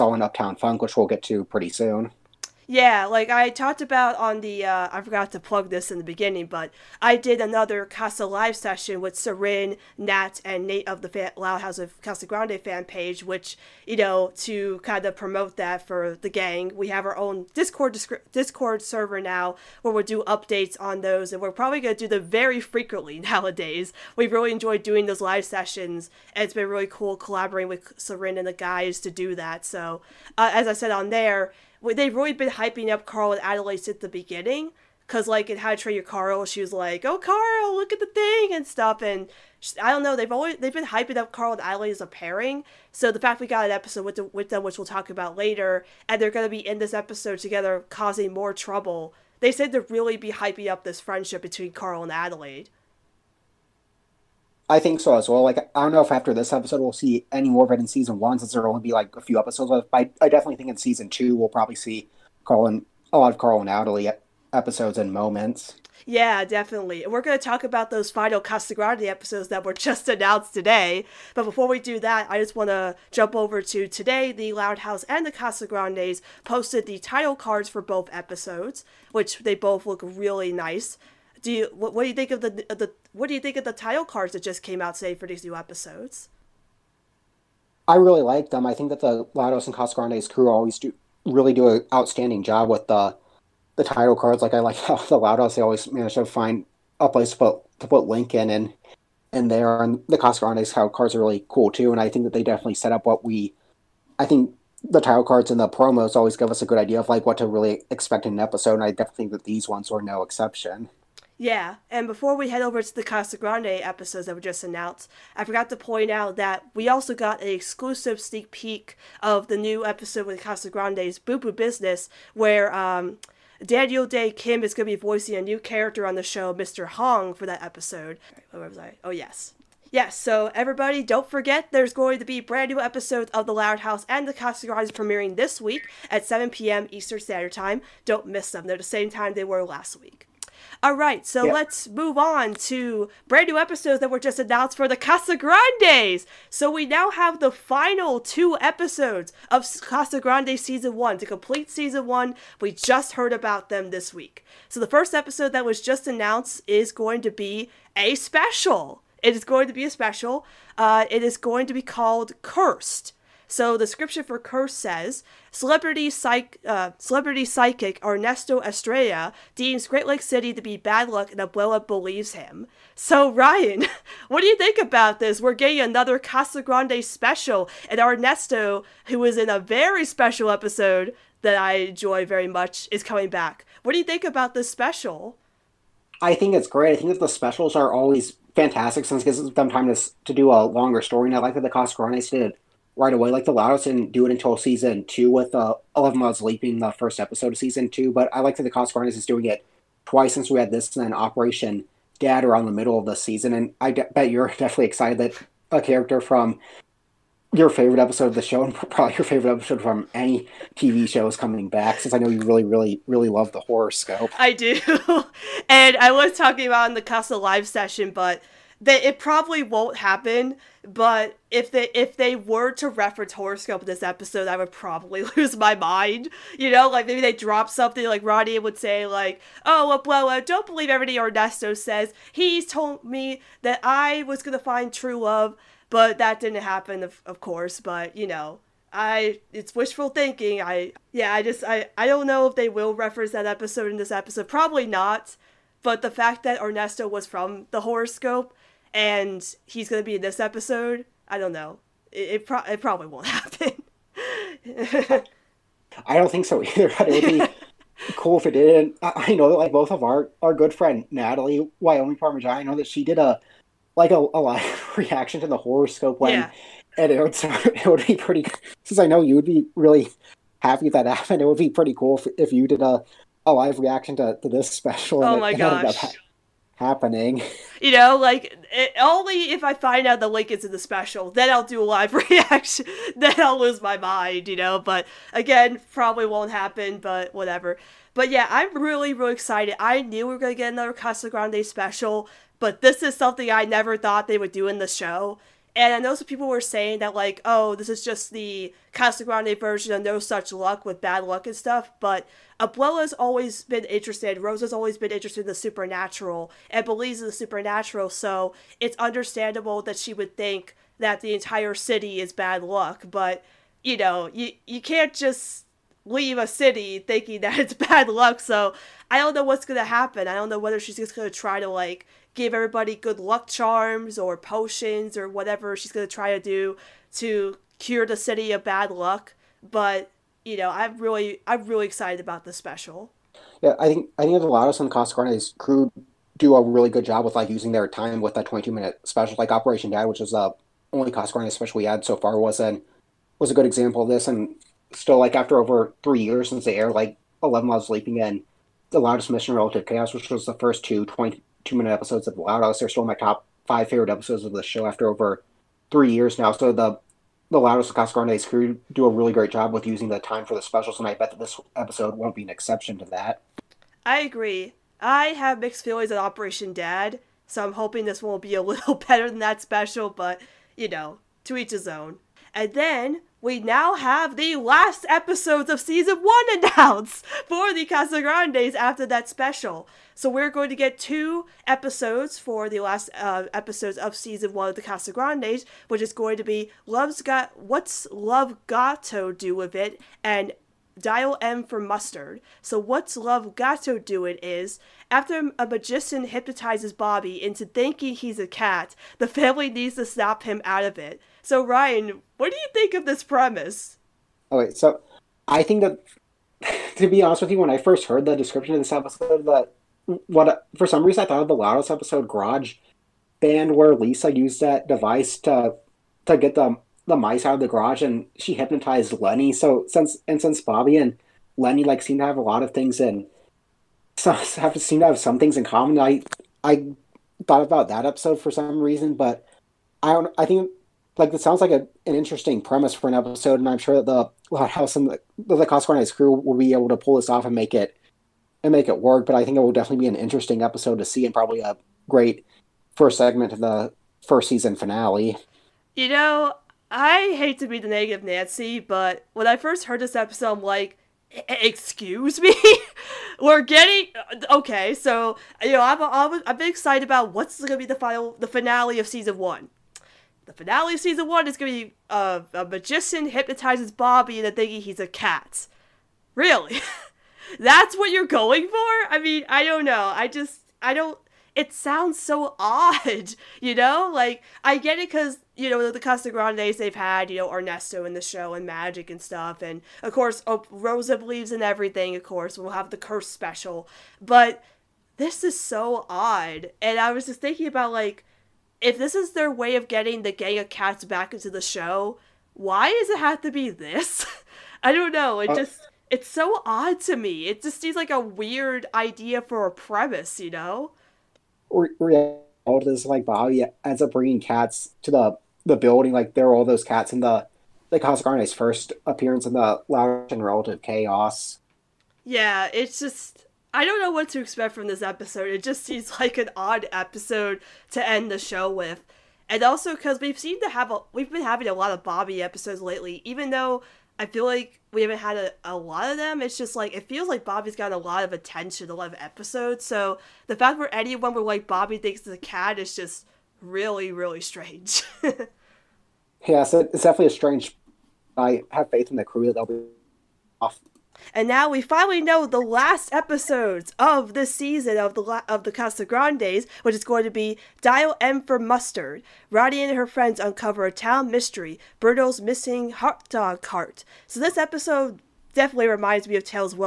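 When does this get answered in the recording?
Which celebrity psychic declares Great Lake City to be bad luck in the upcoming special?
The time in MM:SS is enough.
02:48.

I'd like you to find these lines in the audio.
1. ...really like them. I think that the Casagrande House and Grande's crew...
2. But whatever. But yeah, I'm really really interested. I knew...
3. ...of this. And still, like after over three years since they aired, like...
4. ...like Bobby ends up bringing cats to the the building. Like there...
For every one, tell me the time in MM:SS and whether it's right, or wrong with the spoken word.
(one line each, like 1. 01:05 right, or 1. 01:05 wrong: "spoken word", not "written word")
1. 01:27 wrong: "Loud", not "Casagrande"
2. 04:46 wrong: "excited", not "interested"
3. 05:44 right
4. 08:23 right.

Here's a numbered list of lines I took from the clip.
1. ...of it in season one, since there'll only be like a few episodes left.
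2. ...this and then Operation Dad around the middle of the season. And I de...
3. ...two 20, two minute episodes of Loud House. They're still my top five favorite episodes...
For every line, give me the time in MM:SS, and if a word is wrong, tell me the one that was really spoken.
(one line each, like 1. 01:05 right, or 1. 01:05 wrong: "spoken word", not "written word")
1. 00:57 right
2. 03:20 right
3. 05:50 right.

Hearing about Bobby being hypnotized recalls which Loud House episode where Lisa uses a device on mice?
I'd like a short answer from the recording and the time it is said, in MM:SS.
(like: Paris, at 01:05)
Garage Band, at 06:52.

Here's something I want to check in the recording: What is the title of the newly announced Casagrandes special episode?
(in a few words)
Cursed.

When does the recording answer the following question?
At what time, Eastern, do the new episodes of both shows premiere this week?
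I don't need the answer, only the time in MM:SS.
02:16.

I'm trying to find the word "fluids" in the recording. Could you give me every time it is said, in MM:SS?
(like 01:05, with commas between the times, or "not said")
not said.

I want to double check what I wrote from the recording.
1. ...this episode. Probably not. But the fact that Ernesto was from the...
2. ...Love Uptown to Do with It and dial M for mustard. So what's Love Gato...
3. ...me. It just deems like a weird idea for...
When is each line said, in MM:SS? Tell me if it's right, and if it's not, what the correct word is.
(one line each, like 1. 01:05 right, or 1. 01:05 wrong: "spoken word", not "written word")
1. 04:03 right
2. 06:28 wrong: "Got", not "Uptown"
3. 08:17 wrong: "seems", not "deems".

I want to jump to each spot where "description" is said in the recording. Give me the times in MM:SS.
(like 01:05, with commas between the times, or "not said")
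06:48.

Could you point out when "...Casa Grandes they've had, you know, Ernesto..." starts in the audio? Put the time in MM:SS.
07:56.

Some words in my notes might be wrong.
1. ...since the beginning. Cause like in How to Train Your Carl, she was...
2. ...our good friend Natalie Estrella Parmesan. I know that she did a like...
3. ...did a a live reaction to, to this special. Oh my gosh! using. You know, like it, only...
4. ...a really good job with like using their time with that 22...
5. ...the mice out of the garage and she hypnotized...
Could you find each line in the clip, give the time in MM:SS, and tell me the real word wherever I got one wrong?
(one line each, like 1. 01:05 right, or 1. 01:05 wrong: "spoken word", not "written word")
1. 00:33 right
2. 04:20 wrong: "Wyoming", not "Estrella"
3. 04:32 wrong: "happening", not "using"
4. 05:36 right
5. 06:57 right.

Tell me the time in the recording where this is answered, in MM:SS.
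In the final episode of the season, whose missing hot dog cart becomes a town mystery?
09:12.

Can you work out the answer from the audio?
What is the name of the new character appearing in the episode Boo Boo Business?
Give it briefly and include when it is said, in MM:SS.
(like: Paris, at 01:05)
Mr. Hong, at 02:06.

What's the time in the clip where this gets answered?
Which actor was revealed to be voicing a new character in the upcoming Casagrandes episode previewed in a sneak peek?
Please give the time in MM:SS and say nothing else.
02:03.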